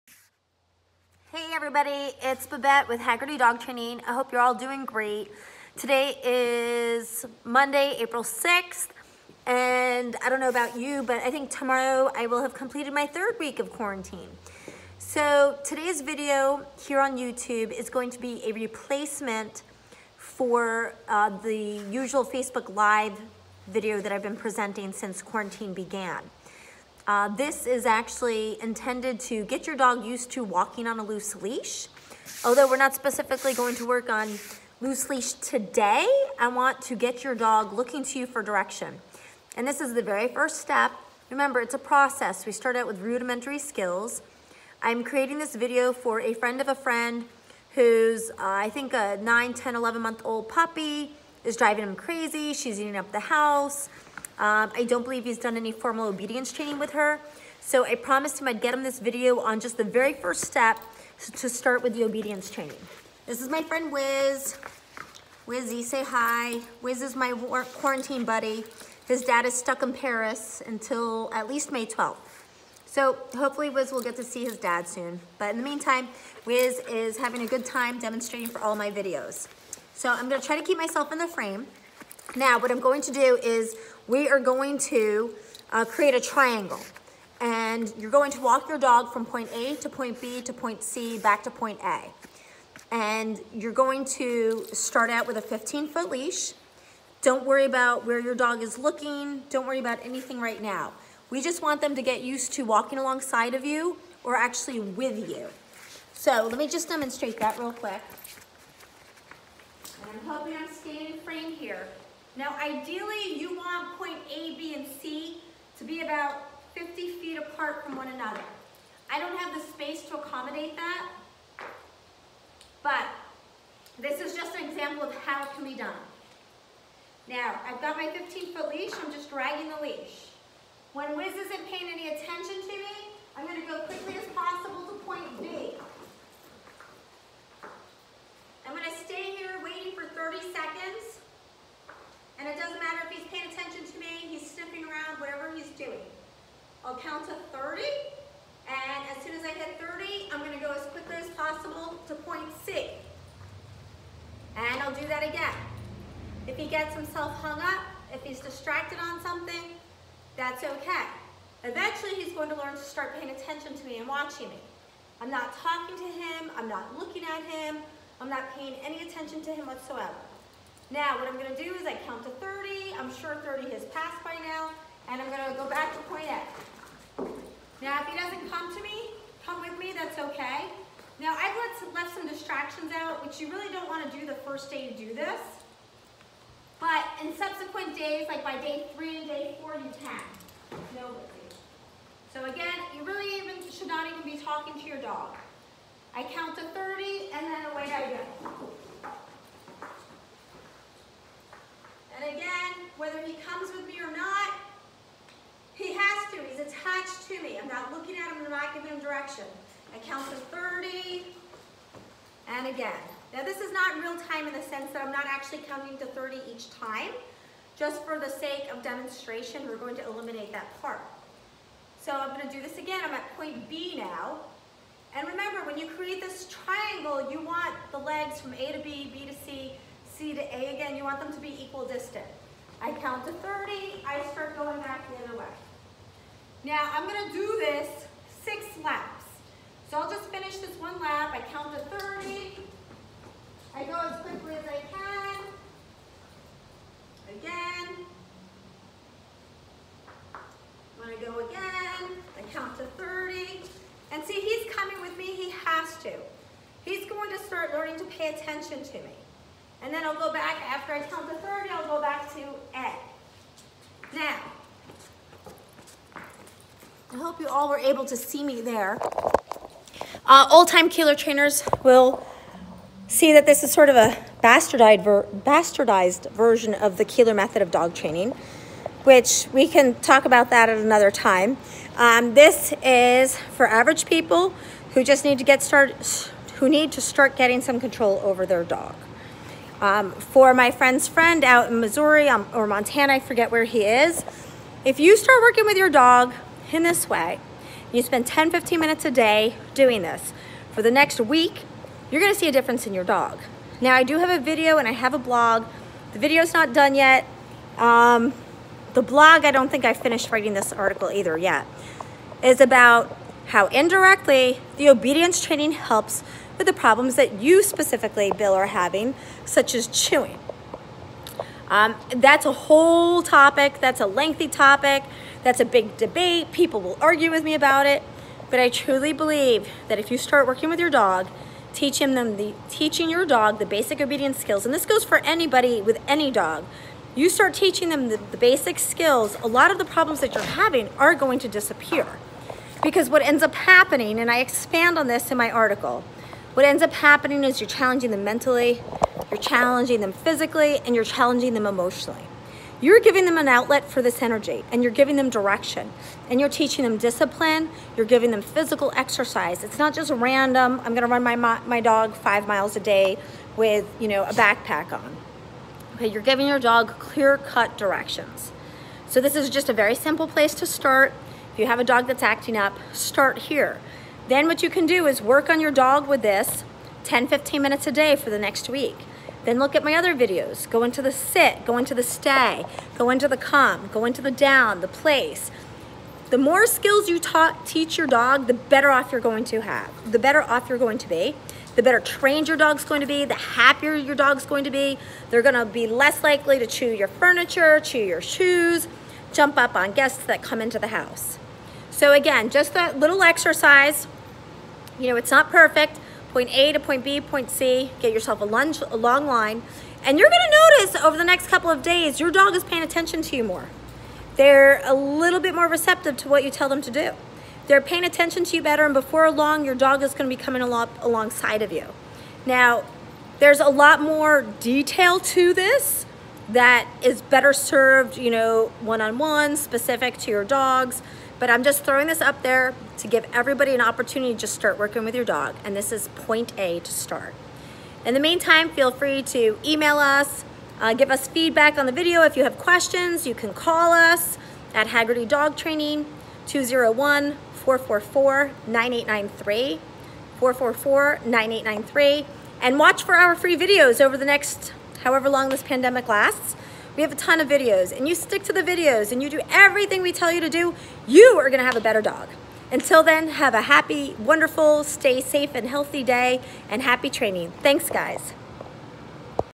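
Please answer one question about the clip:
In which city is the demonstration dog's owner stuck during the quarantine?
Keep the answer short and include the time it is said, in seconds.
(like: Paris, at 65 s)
Paris, at 69 s.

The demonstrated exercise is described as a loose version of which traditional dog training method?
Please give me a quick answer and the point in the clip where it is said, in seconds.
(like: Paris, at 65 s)
Koehler method, at 277 s.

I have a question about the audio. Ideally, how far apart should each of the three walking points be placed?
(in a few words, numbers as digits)
50 feet.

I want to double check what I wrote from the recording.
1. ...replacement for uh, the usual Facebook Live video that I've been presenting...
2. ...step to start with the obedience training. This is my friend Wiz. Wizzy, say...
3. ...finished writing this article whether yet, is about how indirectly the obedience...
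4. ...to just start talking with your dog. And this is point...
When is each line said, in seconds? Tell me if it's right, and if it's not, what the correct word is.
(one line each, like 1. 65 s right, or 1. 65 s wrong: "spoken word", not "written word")
1. 18 s right
2. 60 s right
3. 309 s wrong: "either", not "whether"
4. 434 s wrong: "working", not "talking".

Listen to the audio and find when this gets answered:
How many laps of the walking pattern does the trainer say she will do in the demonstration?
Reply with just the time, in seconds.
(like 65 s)
238 s.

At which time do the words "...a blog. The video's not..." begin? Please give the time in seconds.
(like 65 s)
305 s.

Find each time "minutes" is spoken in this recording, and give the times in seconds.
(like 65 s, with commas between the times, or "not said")
298 s, 377 s.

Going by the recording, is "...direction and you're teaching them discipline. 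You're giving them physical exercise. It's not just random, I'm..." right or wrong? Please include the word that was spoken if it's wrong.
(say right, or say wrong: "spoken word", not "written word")
right.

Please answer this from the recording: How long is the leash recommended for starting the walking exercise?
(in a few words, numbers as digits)
15 feet.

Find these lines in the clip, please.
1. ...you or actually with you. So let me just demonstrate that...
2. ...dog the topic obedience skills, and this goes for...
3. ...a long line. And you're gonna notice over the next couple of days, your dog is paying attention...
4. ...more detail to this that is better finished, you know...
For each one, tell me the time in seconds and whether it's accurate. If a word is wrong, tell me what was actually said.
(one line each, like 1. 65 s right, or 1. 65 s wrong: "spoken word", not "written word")
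1. 103 s right
2. 333 s wrong: "basic", not "topic"
3. 408 s right
4. 424 s wrong: "served", not "finished".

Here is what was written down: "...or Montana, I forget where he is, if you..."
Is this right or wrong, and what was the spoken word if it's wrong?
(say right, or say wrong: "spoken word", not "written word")
right.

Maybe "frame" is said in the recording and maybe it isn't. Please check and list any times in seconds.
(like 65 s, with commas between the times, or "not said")
81 s, 111 s.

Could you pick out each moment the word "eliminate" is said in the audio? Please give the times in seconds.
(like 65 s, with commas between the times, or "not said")
220 s.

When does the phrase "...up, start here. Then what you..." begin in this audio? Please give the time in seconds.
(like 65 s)
372 s.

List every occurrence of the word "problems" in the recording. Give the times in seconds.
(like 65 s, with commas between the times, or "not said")
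316 s, 339 s.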